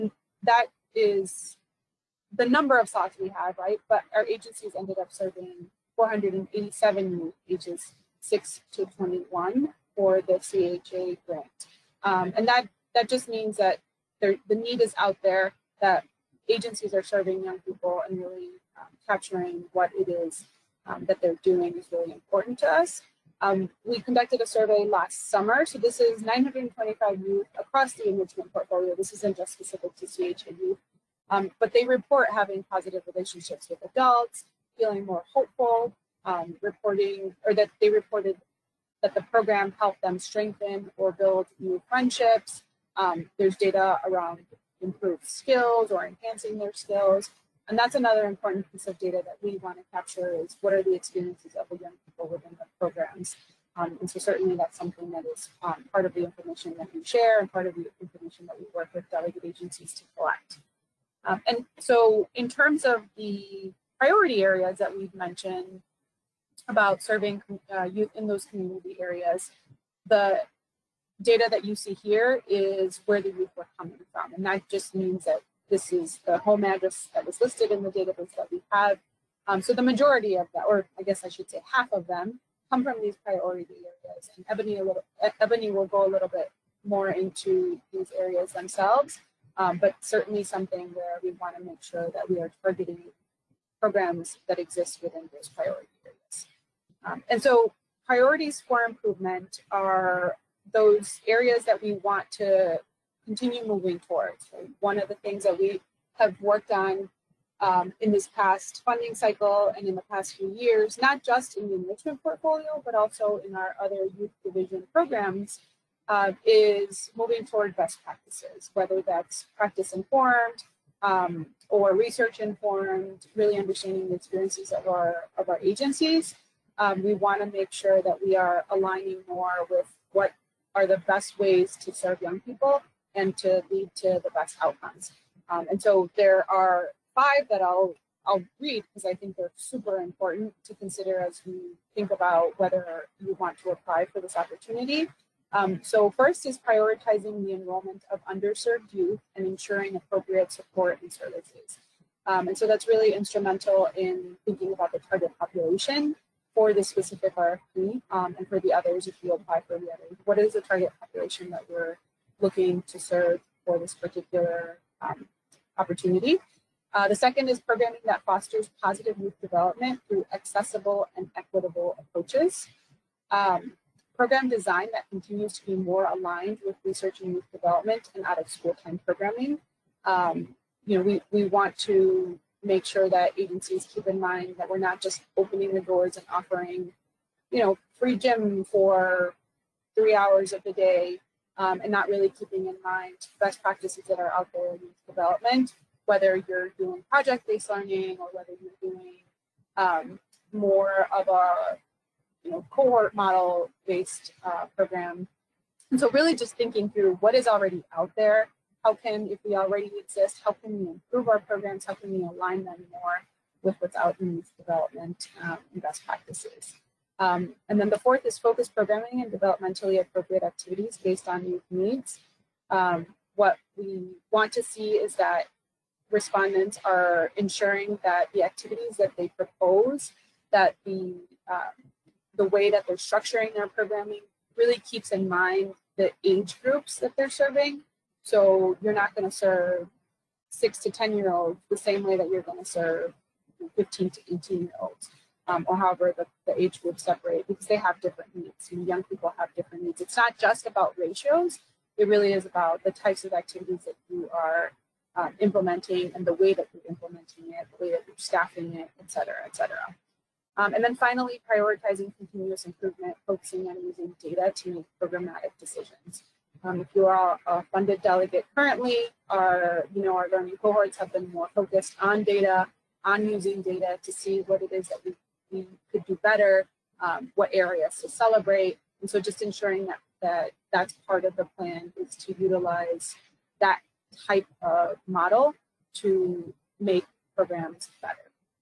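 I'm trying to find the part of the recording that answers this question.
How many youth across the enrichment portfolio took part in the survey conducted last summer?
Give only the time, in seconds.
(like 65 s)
26 s.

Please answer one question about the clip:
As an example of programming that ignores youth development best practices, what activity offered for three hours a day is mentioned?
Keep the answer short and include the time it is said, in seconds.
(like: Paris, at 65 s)
Free gym, at 187 s.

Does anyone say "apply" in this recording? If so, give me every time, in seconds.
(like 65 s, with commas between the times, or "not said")
143 s, 159 s.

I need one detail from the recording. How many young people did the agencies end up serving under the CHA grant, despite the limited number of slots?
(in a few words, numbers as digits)
487.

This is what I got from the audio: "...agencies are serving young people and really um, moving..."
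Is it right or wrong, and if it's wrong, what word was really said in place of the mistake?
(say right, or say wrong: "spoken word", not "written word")
wrong: "capturing", not "moving".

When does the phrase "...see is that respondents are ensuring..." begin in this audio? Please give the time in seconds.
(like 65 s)
224 s.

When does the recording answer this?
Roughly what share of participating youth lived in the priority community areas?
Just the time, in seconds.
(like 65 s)
81 s.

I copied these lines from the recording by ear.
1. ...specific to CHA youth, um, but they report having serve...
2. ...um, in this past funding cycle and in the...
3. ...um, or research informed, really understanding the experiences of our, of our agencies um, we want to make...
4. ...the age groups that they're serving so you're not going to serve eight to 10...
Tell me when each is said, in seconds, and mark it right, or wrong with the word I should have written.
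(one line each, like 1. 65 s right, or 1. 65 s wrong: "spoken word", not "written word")
1. 29 s wrong: "positive", not "serve"
2. 107 s right
3. 121 s right
4. 235 s wrong: "six", not "eight".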